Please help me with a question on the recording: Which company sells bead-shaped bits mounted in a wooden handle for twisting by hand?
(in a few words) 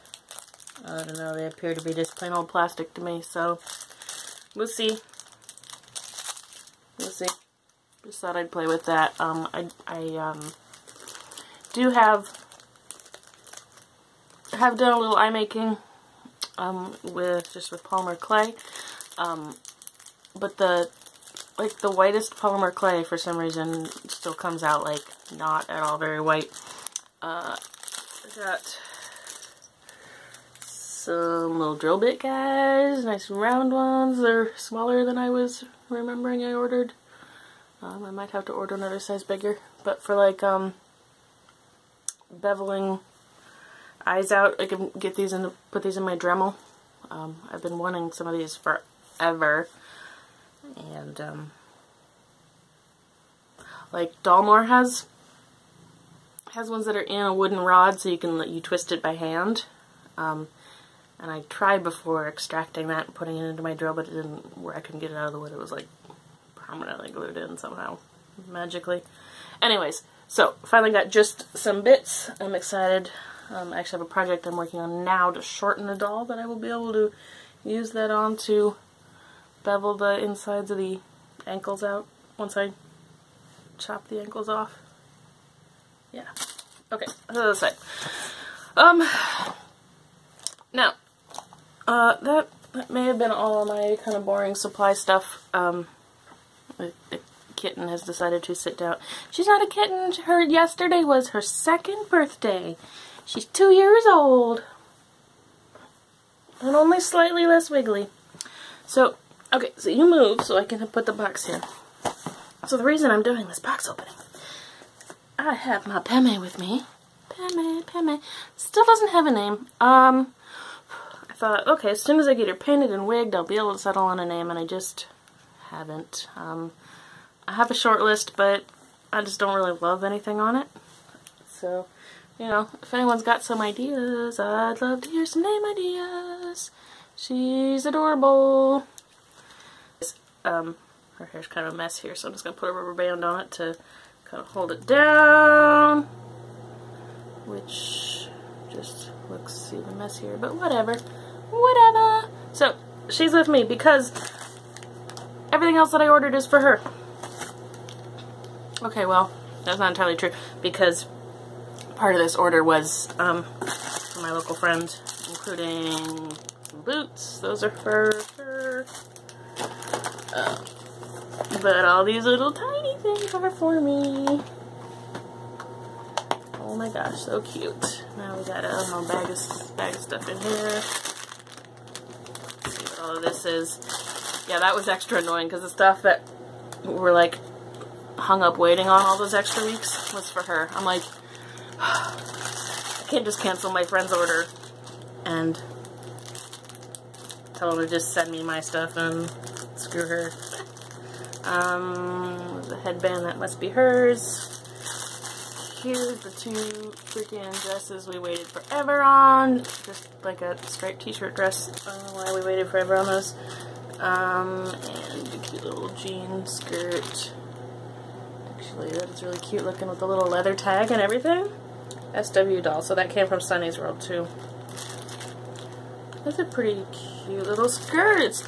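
Dollmore.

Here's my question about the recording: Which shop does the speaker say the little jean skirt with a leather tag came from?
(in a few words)
Sunny's World.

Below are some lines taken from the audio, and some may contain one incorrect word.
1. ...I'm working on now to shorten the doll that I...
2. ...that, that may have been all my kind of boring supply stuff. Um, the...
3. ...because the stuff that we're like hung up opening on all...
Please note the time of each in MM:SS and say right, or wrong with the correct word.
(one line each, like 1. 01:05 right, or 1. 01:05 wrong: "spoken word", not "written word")
1. 01:14 right
2. 01:32 right
3. 03:05 wrong: "waiting", not "opening".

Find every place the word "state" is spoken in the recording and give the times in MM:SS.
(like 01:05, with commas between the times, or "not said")
not said.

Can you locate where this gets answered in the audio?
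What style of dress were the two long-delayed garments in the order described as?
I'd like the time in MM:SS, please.
03:30.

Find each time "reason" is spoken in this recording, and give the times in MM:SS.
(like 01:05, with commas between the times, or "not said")
00:23, 01:52.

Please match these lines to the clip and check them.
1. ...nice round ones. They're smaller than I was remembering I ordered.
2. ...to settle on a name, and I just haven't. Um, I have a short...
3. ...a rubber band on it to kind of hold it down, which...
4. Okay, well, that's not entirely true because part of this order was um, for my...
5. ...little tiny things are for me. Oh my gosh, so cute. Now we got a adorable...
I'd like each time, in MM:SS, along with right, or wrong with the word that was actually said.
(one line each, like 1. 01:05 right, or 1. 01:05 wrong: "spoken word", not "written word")
1. 00:33 right
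2. 02:03 right
3. 02:22 right
4. 02:38 right
5. 02:52 wrong: "whole", not "adorable".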